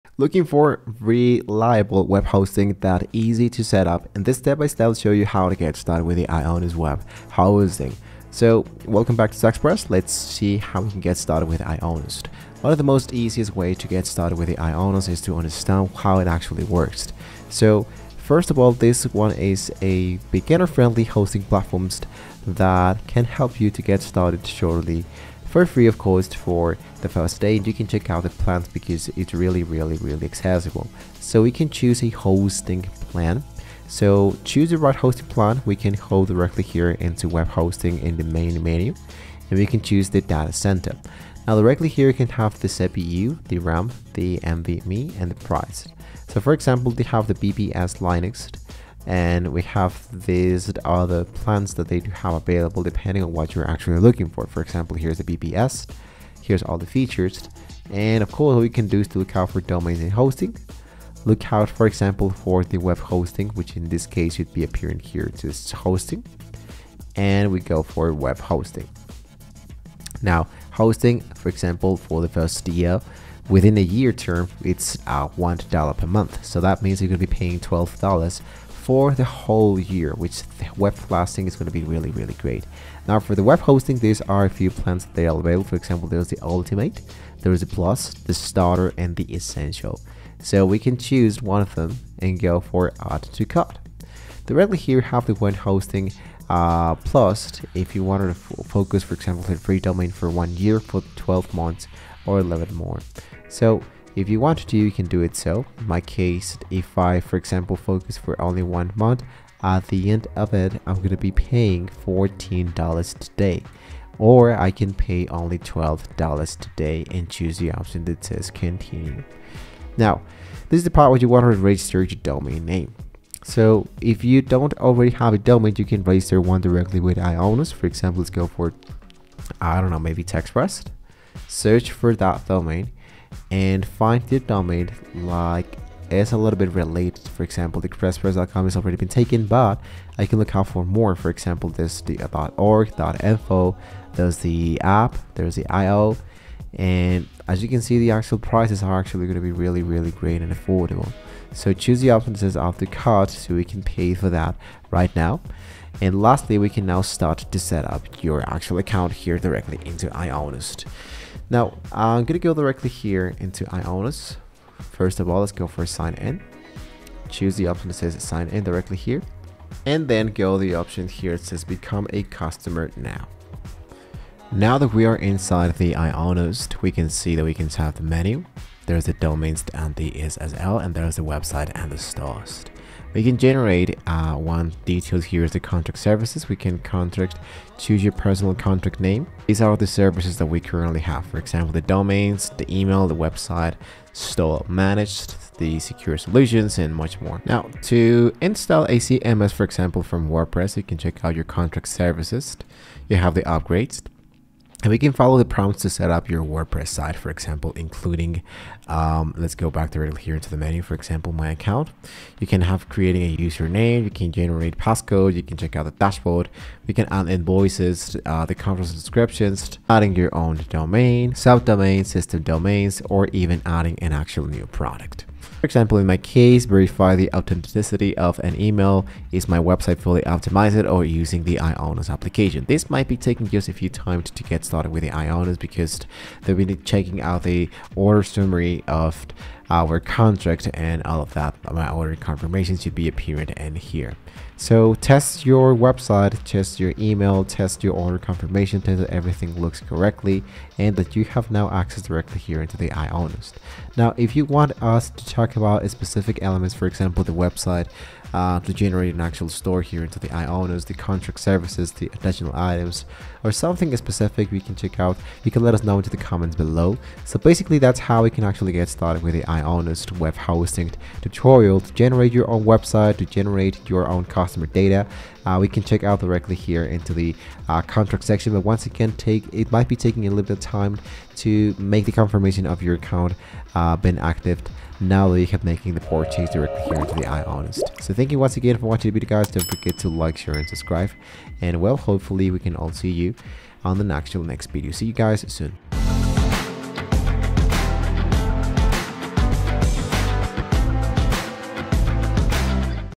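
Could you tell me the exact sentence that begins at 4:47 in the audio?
So thank you once again for watching the video guys.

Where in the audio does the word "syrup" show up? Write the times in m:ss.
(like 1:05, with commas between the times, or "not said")
not said.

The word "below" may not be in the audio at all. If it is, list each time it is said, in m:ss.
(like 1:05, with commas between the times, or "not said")
4:26.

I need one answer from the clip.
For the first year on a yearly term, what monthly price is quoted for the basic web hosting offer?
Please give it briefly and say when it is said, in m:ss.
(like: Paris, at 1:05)
$1 per month, at 1:15.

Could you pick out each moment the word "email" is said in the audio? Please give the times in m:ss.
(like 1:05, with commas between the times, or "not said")
3:12, 3:48, 4:06.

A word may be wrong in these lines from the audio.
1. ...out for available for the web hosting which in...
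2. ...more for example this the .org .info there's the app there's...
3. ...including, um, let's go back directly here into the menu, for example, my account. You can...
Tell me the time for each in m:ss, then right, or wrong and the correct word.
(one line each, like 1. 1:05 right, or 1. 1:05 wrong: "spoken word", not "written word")
1. 1:01 wrong: "example", not "available"
2. 2:20 right
3. 3:27 right.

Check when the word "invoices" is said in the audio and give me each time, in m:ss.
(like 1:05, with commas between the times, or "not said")
3:37.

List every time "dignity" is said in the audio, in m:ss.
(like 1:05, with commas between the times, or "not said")
not said.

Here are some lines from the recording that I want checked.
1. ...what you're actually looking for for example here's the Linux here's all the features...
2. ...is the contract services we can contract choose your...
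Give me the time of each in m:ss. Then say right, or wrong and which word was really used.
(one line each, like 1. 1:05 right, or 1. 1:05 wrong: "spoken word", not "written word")
1. 0:53 wrong: "VPS", not "Linux"
2. 3:05 right.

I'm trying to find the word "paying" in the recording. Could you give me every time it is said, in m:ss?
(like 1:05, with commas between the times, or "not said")
1:17, 1:51.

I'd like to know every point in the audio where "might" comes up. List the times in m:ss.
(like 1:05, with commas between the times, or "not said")
3:52, 4:39.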